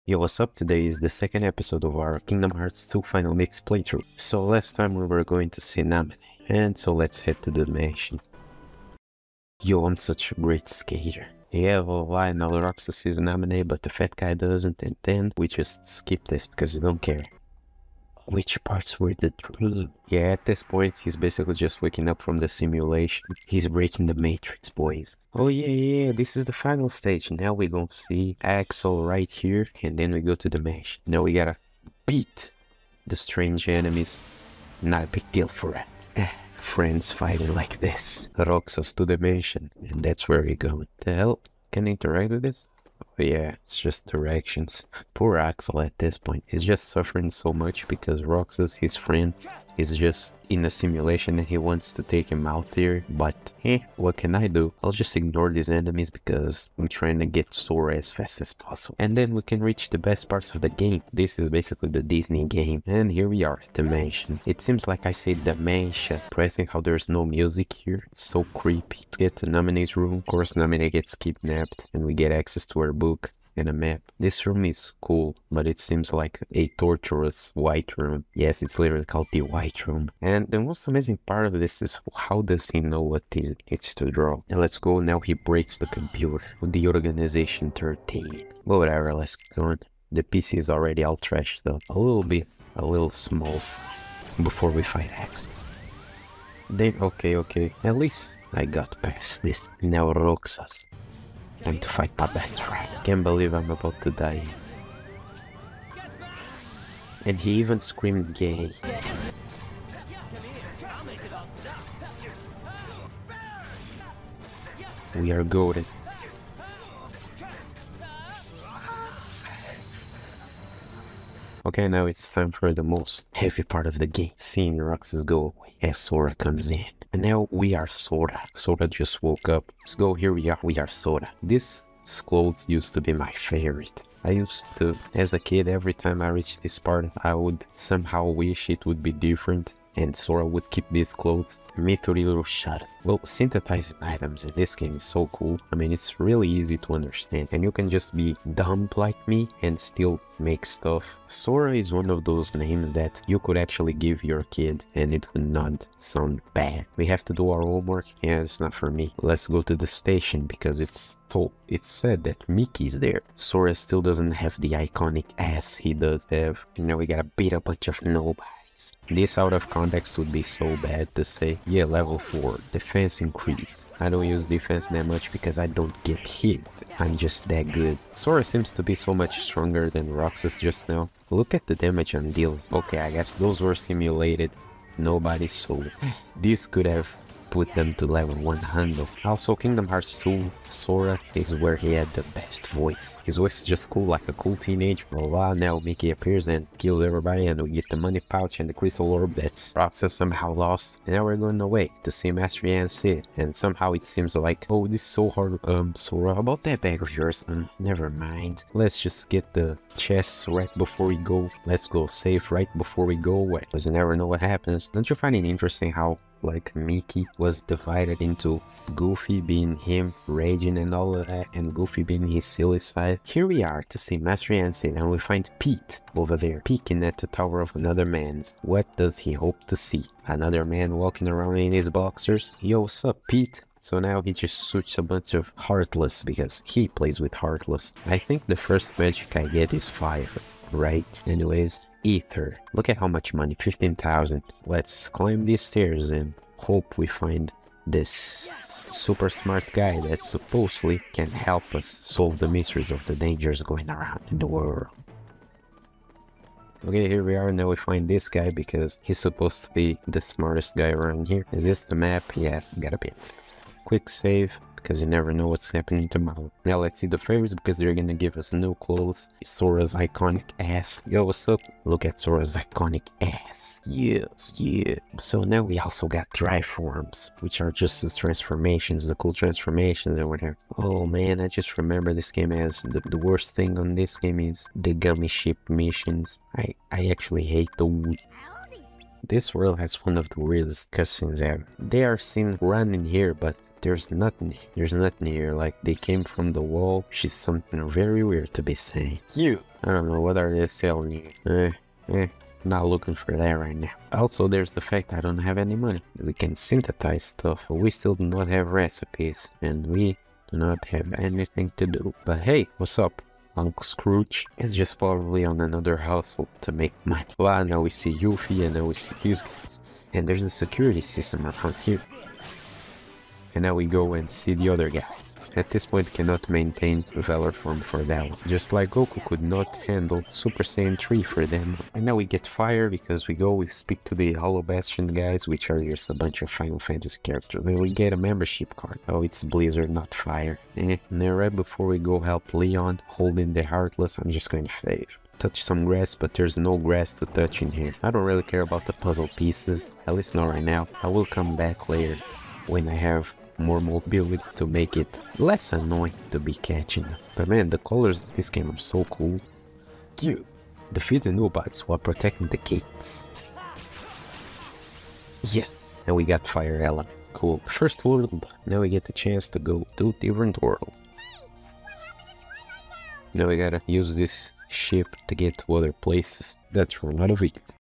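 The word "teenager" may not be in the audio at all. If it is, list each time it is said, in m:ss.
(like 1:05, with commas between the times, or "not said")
3:14.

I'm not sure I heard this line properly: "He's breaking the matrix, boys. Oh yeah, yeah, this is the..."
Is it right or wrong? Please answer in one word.
right.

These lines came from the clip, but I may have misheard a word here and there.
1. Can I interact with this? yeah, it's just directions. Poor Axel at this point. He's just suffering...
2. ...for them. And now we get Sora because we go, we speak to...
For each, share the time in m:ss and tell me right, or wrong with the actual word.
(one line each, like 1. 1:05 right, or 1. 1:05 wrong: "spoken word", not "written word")
1. 0:41 right
2. 5:31 wrong: "Fire", not "Sora".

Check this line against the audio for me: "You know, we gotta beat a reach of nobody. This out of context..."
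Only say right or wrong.
wrong.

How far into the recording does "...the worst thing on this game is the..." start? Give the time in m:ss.
4:43.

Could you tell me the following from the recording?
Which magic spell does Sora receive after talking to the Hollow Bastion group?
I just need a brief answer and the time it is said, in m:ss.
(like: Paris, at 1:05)
Blizzard, at 5:39.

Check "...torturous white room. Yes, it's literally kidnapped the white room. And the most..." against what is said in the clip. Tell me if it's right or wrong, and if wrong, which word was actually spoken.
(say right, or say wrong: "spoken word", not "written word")
wrong: "called", not "kidnapped".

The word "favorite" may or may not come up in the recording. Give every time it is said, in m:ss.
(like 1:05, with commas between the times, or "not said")
2:13, 4:27.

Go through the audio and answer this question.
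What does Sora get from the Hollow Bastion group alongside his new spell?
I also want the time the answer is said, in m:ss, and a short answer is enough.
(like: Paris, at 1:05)
A membership card, at 5:38.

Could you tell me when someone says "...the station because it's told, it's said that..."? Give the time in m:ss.
2:39.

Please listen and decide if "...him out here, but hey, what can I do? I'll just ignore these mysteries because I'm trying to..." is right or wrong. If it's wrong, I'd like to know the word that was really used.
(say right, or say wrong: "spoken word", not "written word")
wrong: "enemies", not "mysteries".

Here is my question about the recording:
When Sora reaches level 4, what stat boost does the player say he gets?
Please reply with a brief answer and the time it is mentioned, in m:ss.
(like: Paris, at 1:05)
Defense increase, at 2:52.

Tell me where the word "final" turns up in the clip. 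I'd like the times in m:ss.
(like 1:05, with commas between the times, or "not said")
0:03, 0:26, 5:36.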